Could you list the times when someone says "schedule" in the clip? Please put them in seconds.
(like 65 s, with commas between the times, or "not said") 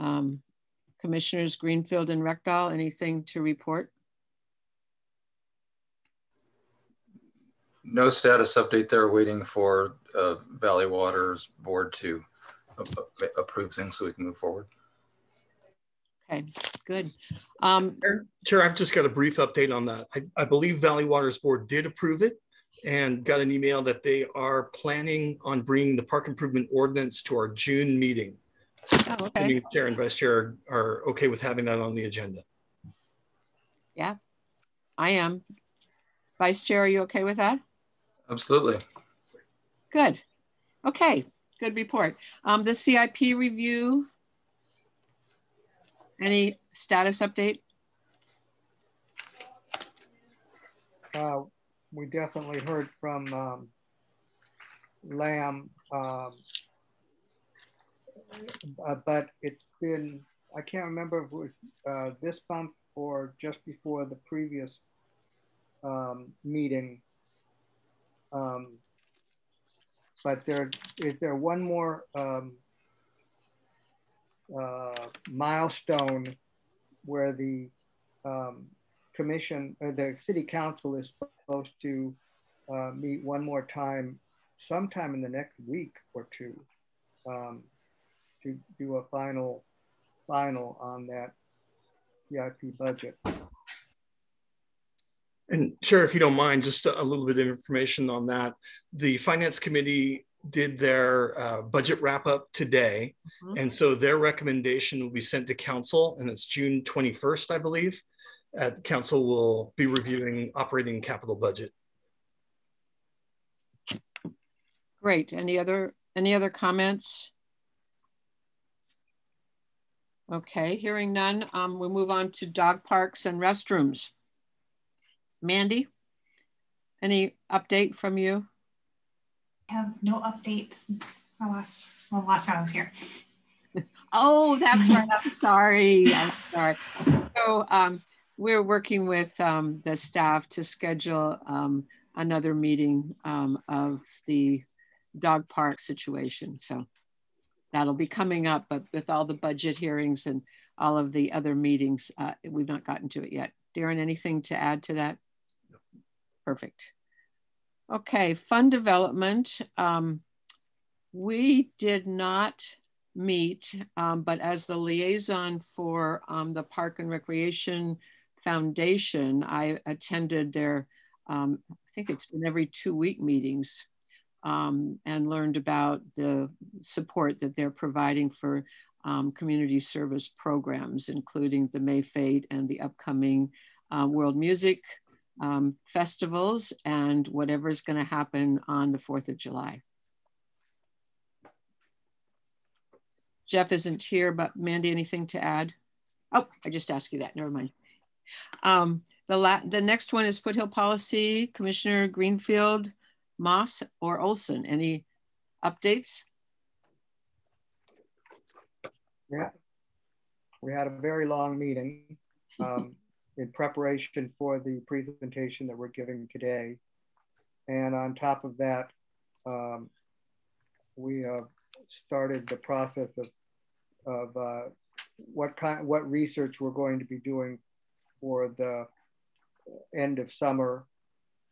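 140 s.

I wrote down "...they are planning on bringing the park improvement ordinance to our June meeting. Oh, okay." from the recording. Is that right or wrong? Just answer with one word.
right.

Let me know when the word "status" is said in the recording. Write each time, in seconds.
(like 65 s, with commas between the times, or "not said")
8 s, 46 s.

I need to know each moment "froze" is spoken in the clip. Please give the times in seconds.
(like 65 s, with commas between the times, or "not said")
not said.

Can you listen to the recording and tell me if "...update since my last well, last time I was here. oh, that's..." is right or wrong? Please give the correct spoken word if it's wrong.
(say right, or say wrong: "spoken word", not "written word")
right.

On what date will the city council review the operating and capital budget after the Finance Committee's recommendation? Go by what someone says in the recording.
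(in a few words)
June 21st.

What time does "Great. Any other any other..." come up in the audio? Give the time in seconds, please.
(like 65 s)
115 s.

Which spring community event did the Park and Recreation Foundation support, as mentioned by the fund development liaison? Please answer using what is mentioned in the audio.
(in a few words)
May Fete.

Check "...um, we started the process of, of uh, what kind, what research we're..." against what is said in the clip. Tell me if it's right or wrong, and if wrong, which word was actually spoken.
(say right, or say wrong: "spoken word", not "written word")
right.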